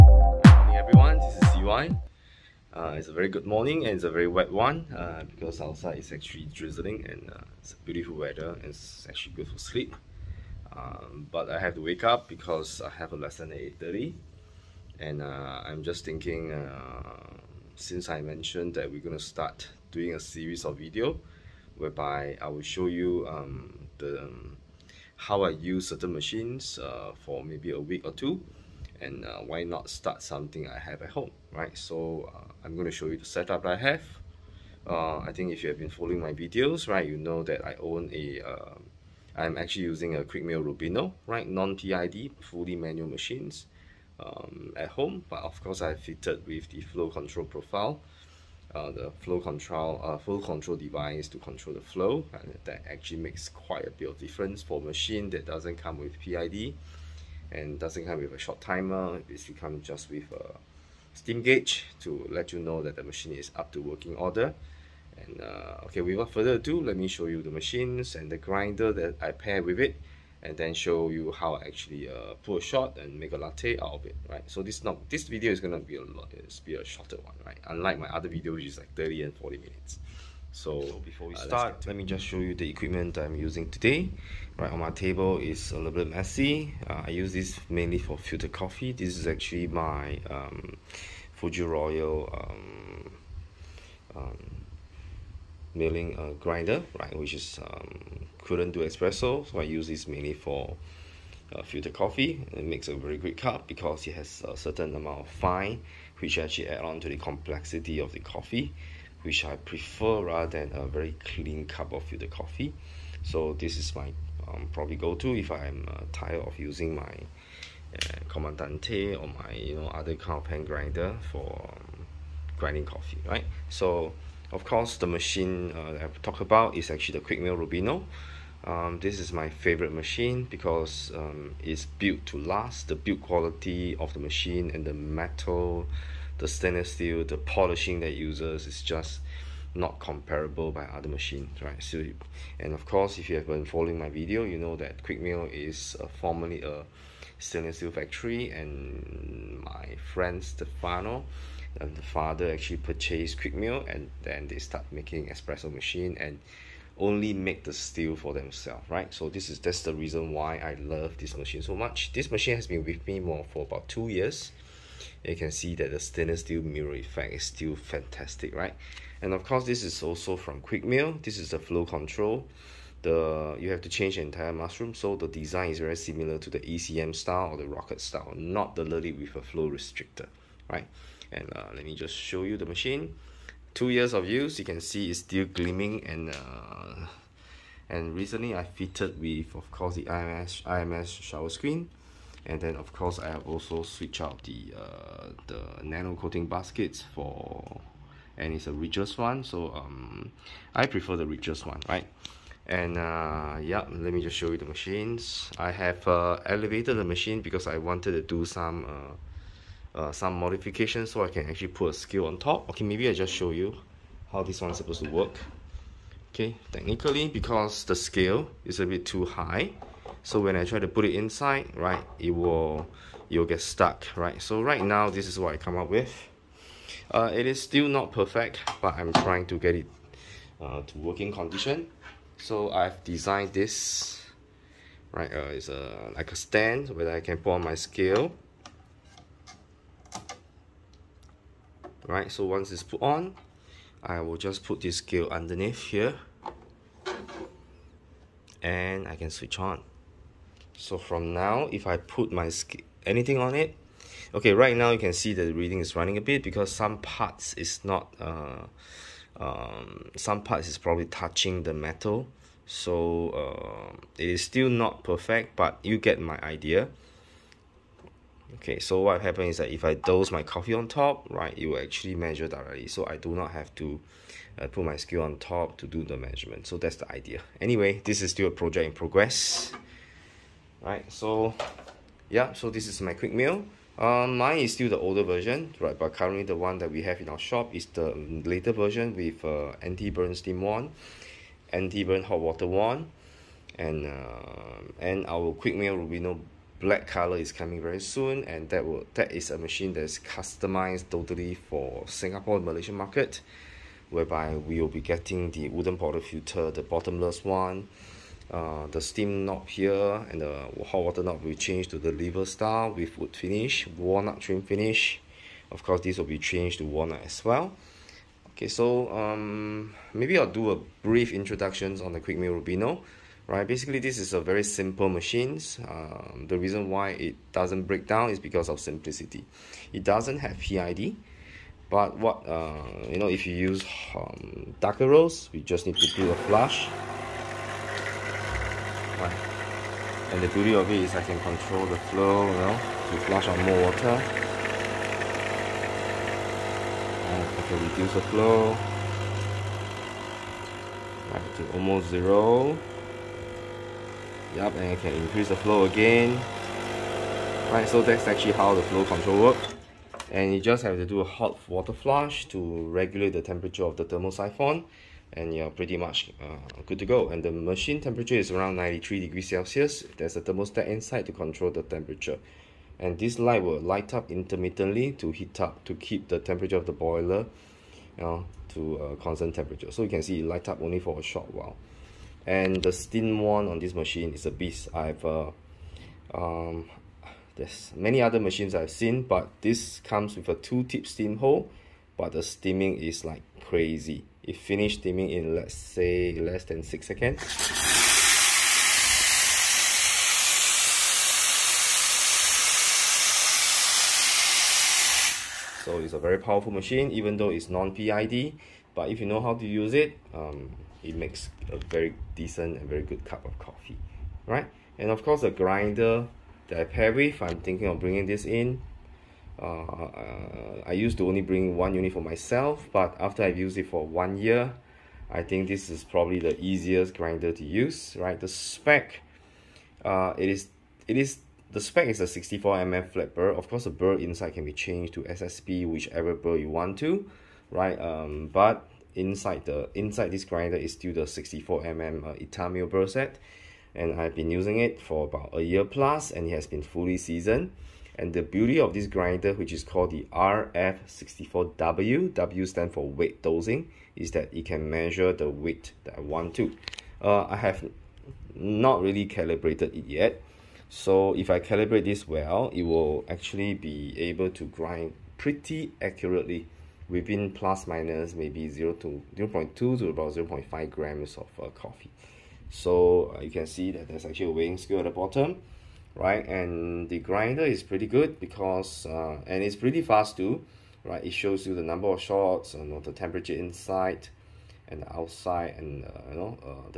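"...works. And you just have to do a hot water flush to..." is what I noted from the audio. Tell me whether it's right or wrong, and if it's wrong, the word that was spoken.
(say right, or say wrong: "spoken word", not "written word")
right.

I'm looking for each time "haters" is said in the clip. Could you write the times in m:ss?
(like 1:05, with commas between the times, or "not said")
not said.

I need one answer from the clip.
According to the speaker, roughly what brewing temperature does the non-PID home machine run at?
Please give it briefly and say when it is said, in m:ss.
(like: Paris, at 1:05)
93 degrees Celsius, at 6:08.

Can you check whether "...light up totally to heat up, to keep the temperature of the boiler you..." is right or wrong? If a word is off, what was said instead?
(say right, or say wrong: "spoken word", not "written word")
wrong: "intermittently", not "totally".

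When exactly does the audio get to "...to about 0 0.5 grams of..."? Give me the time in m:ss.
7:49.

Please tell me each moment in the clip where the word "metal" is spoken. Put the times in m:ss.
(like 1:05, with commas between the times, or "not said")
2:14, 4:21.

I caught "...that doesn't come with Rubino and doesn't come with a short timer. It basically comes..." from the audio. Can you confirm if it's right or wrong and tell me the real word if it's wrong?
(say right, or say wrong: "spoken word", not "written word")
wrong: "PID", not "Rubino".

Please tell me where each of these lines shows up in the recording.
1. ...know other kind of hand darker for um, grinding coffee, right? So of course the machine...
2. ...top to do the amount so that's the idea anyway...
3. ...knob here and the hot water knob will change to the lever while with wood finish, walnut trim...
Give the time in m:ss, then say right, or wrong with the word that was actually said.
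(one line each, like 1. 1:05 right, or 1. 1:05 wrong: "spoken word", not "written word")
1. 1:59 wrong: "grinder", not "darker"
2. 4:35 wrong: "measurement", not "amount"
3. 5:09 wrong: "style", not "while".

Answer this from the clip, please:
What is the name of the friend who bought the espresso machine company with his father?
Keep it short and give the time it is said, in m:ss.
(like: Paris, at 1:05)
Stefano, at 2:30.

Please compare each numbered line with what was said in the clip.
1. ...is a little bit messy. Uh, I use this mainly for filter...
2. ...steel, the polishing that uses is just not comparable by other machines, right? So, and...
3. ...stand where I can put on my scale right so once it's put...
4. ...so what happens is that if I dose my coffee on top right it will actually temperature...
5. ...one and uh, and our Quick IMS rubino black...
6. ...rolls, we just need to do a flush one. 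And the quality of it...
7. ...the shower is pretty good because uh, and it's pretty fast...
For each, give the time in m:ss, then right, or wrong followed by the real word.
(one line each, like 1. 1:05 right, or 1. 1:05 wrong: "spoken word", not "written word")
1. 1:25 right
2. 2:16 right
3. 3:56 right
4. 4:28 wrong: "measure", not "temperature"
5. 4:52 wrong: "Mill", not "IMS"
6. 5:35 wrong: "beauty", not "quality"
7. 7:57 wrong: "grinder", not "shower".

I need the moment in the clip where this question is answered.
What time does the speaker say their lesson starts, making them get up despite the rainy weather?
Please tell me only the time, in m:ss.
0:13.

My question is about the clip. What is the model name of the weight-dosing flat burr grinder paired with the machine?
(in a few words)
RF64W.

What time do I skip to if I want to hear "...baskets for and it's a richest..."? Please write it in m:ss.
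3:16.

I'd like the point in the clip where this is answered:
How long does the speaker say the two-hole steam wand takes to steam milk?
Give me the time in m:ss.
6:36.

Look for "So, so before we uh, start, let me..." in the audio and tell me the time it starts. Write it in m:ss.
1:20.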